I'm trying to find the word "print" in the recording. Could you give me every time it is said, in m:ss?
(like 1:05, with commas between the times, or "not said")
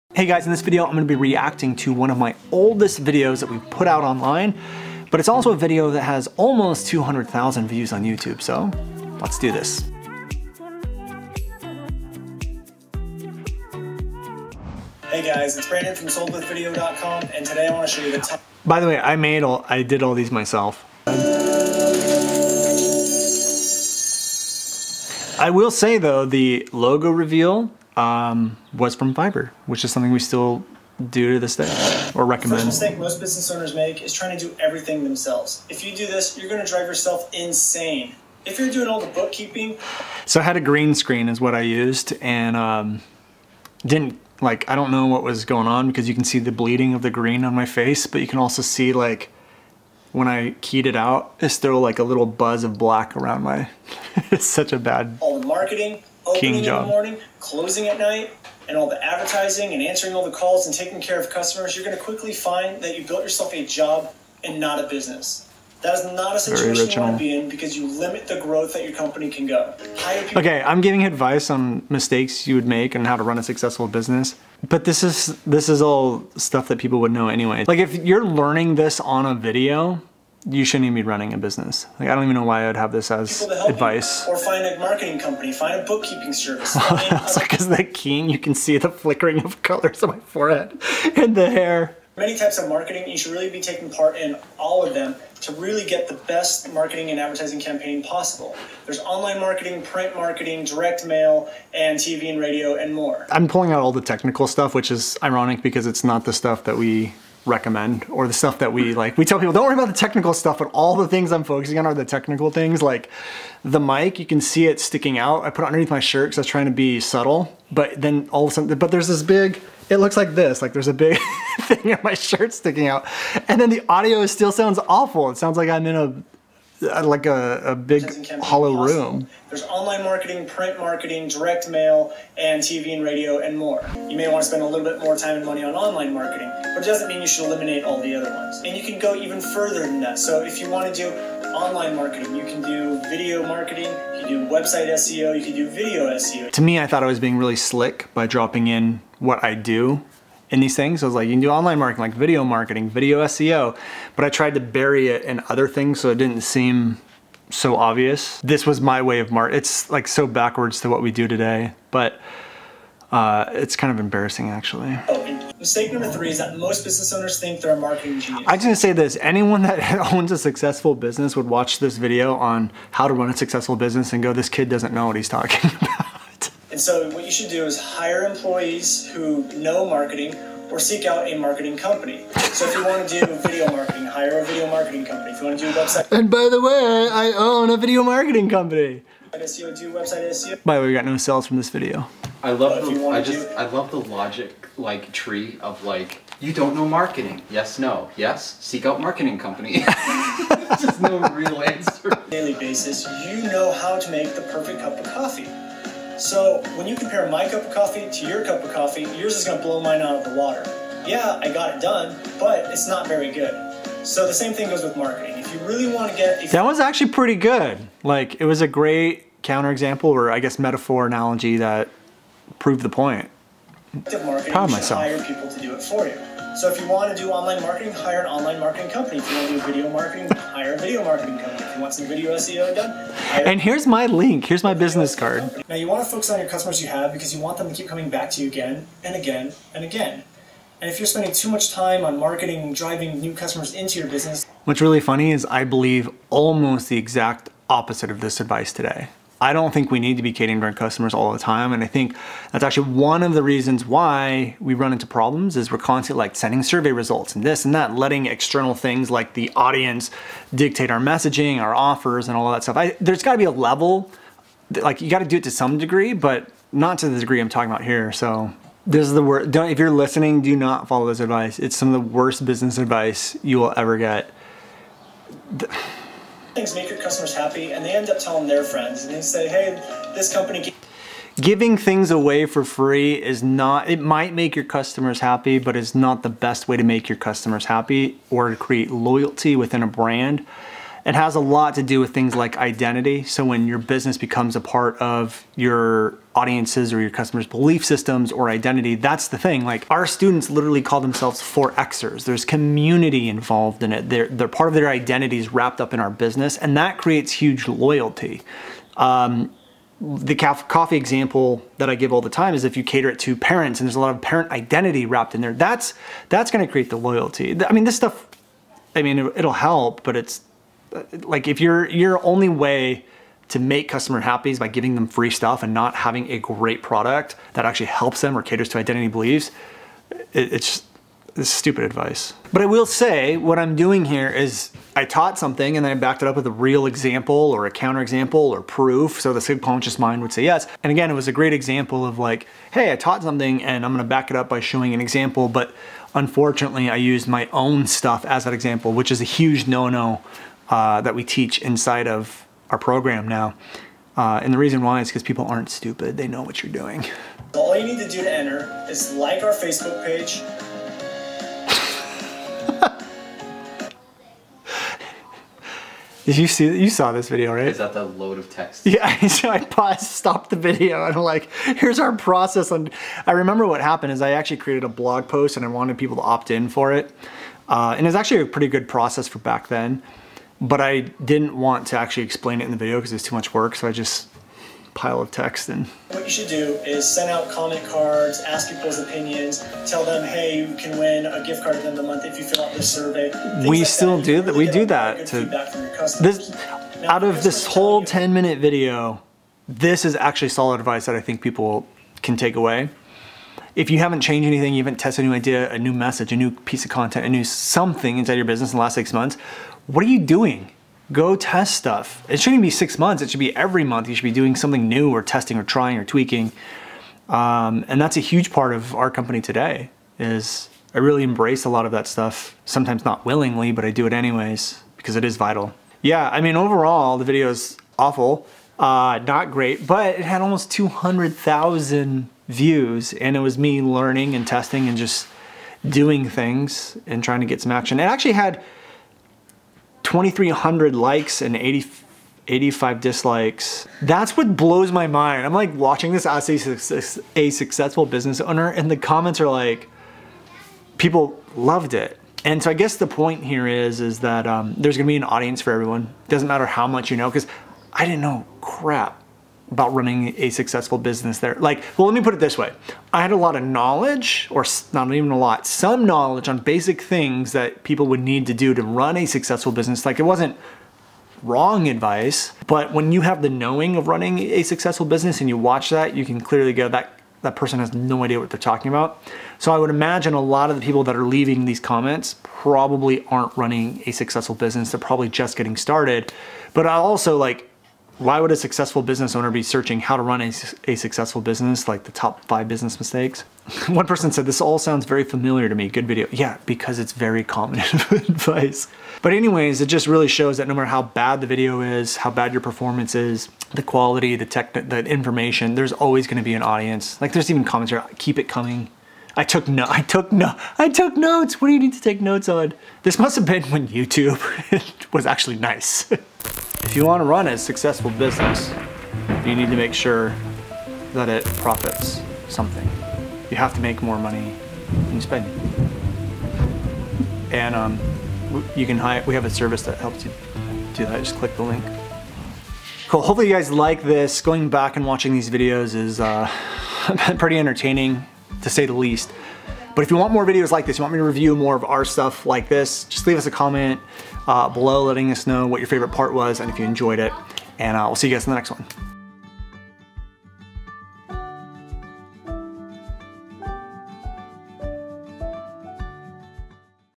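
1:39, 2:10.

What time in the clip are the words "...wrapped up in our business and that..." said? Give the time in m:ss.
5:05.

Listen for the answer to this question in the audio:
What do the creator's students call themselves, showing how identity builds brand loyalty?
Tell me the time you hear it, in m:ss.
5:01.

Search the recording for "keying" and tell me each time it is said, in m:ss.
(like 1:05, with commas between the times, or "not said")
0:56, 1:27.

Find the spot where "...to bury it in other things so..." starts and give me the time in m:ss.
2:34.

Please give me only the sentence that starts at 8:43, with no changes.
You have to make more money than you spend.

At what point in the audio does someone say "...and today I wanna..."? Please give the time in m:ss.
0:17.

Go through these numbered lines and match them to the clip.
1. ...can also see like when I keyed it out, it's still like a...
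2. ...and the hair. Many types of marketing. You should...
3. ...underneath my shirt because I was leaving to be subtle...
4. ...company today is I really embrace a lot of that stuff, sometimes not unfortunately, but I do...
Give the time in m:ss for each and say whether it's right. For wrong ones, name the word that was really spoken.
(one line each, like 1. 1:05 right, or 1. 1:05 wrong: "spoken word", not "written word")
1. 0:48 right
2. 1:31 right
3. 1:55 wrong: "trying", not "leaving"
4. 6:59 wrong: "willingly", not "unfortunately".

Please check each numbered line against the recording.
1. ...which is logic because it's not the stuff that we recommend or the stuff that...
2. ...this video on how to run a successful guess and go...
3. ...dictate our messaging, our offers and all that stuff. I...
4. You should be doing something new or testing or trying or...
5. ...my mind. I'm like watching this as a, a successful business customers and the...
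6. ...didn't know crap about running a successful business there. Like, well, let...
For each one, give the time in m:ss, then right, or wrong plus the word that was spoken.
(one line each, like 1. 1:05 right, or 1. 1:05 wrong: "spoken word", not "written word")
1. 1:44 wrong: "ironic", not "logic"
2. 2:51 wrong: "business", not "guess"
3. 4:20 right
4. 6:54 right
5. 7:24 wrong: "owner", not "customers"
6. 7:38 right.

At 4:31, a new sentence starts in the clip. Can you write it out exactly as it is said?
It's some of the worst business advice you will ever get.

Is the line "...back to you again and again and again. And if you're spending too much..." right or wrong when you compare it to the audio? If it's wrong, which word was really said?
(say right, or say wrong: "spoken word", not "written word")
right.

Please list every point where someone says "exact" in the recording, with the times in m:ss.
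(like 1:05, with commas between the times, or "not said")
4:06.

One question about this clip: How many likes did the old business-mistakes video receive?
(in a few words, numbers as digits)
2,300.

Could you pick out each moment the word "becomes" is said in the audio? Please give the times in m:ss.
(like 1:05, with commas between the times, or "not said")
4:54.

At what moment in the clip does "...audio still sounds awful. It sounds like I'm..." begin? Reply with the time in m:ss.
2:03.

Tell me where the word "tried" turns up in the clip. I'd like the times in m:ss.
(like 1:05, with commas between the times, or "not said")
2:34.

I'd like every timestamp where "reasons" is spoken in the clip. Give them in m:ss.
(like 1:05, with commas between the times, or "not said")
4:13, 5:54.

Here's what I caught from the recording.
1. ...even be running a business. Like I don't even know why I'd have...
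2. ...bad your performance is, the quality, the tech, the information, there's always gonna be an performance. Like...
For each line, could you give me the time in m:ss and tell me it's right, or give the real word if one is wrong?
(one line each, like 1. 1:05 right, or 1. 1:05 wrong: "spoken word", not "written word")
1. 1:20 right
2. 8:22 wrong: "audience", not "performance".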